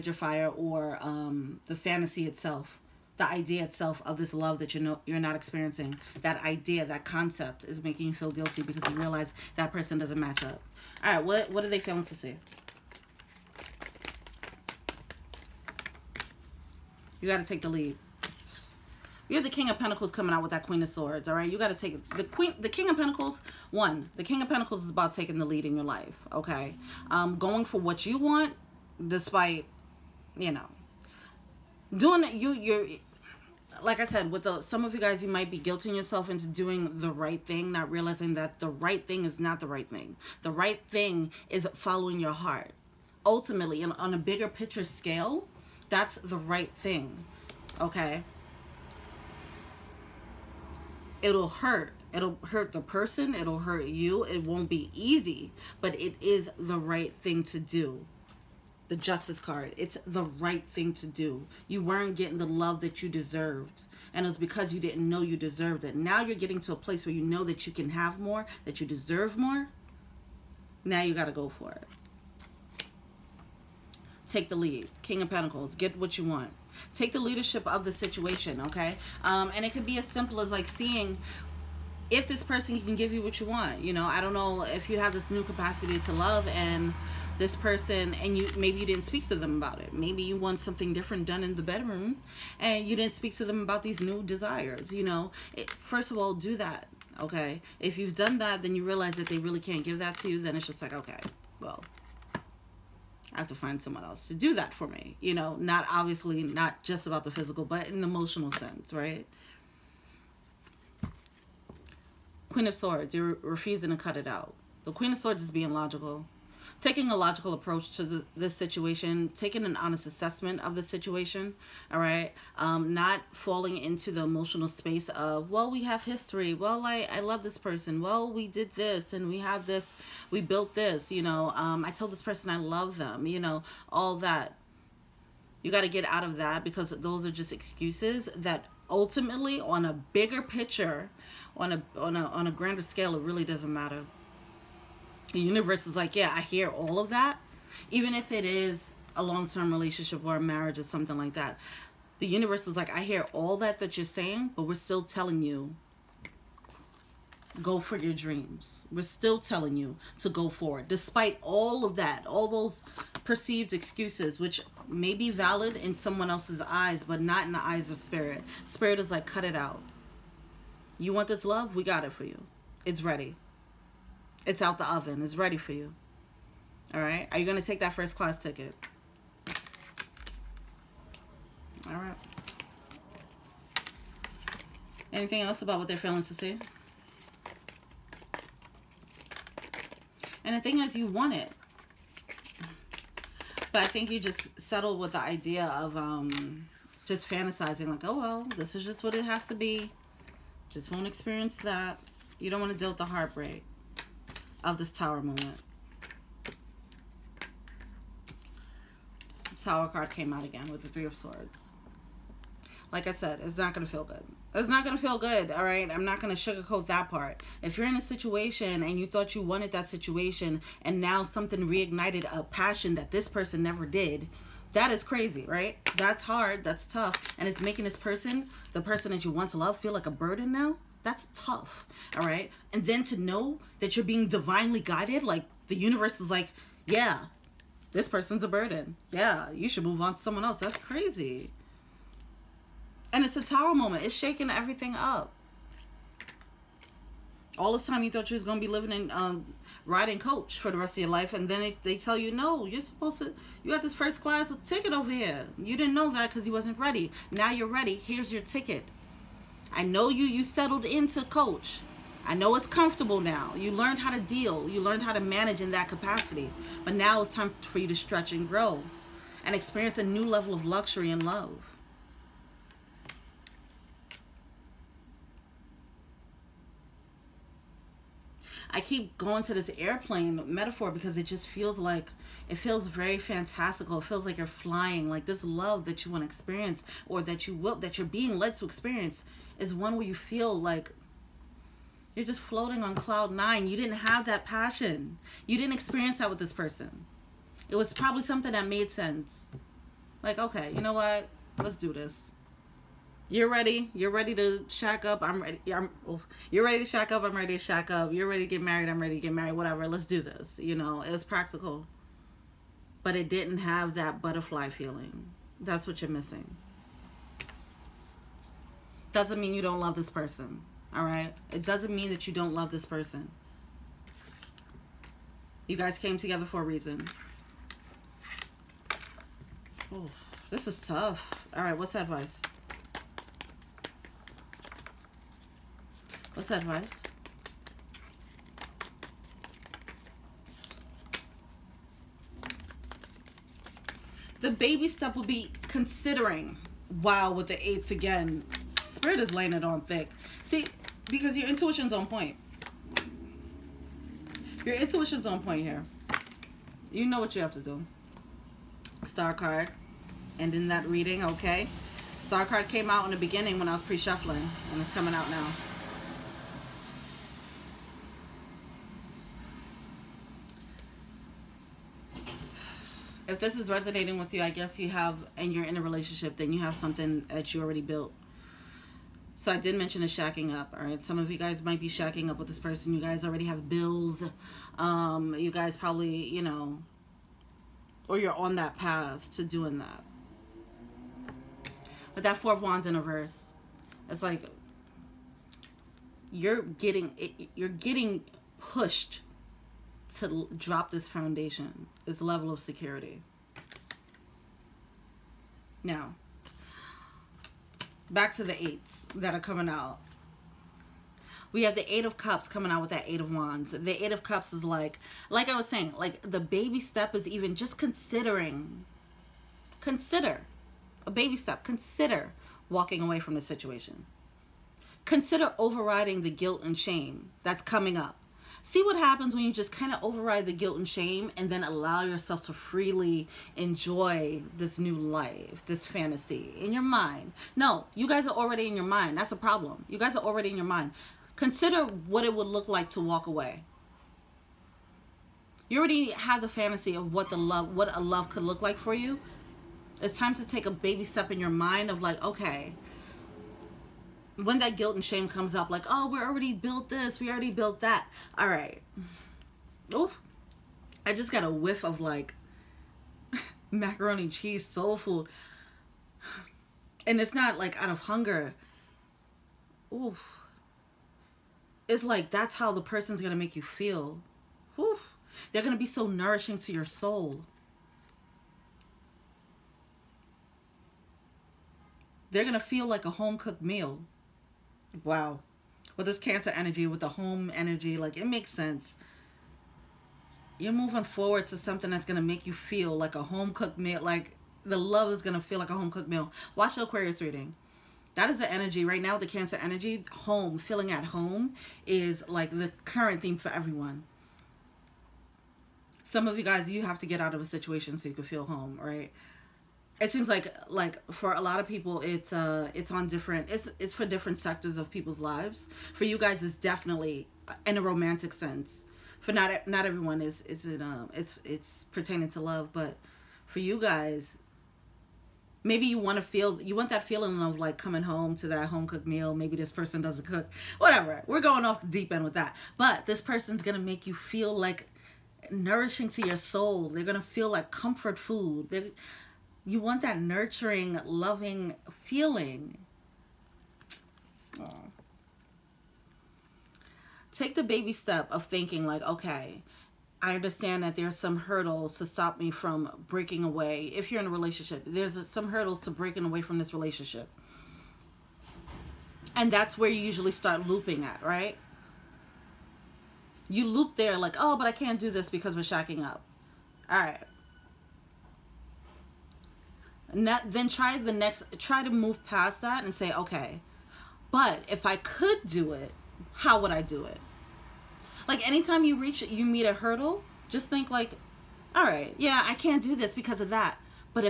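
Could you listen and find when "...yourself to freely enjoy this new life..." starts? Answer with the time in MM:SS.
07:12.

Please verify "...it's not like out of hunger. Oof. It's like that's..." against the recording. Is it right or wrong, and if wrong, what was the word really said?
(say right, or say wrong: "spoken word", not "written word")
right.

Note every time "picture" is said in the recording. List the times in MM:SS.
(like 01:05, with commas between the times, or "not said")
00:44, 02:20.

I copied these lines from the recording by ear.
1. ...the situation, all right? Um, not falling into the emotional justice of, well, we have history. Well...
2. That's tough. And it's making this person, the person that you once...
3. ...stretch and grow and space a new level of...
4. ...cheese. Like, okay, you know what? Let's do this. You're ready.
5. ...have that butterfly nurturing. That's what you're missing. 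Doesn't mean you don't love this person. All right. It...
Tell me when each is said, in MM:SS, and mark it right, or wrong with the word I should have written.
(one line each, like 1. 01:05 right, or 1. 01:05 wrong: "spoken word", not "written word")
1. 02:00 wrong: "space", not "justice"
2. 03:46 right
3. 04:27 wrong: "experience", not "space"
4. 04:58 wrong: "sense", not "cheese"
5. 05:13 wrong: "feeling", not "nurturing".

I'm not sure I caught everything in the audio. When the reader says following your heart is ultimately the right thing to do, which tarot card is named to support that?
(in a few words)
Justice.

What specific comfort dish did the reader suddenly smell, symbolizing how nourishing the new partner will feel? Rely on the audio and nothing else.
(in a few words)
Macaroni cheese.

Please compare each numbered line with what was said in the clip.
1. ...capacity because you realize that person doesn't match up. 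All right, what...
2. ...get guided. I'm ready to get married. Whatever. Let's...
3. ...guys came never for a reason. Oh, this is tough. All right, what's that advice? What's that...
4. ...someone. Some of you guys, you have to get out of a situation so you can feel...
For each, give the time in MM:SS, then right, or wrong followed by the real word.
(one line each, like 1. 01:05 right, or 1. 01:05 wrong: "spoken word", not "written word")
1. 00:08 wrong: "guilty", not "capacity"
2. 05:08 wrong: "married", not "guided"
3. 05:25 wrong: "together", not "never"
4. 08:23 wrong: "everyone", not "someone".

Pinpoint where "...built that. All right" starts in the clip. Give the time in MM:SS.
07:37.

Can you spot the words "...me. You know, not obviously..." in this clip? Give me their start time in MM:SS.
01:44.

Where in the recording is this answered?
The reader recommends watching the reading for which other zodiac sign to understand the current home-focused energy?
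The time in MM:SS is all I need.
08:16.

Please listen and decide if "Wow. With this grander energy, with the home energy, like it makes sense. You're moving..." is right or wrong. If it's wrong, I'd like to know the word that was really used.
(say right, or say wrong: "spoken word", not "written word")
wrong: "cancer", not "grander".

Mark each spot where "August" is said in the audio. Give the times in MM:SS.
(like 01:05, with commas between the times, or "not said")
not said.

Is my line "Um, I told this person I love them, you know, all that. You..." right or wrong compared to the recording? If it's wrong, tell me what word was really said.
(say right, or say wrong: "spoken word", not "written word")
right.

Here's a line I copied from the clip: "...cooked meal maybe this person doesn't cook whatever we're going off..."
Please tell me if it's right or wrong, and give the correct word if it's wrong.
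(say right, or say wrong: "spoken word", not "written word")
right.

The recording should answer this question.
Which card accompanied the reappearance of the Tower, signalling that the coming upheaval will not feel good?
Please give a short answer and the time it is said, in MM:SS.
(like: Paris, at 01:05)
Three of Swords, at 03:30.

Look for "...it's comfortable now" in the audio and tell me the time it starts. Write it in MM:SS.
04:22.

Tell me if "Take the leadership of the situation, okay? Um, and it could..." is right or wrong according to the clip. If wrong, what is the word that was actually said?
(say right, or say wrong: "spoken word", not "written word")
right.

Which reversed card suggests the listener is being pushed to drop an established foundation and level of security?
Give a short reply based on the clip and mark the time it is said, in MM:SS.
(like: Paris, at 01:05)
Four of Wands, at 06:32.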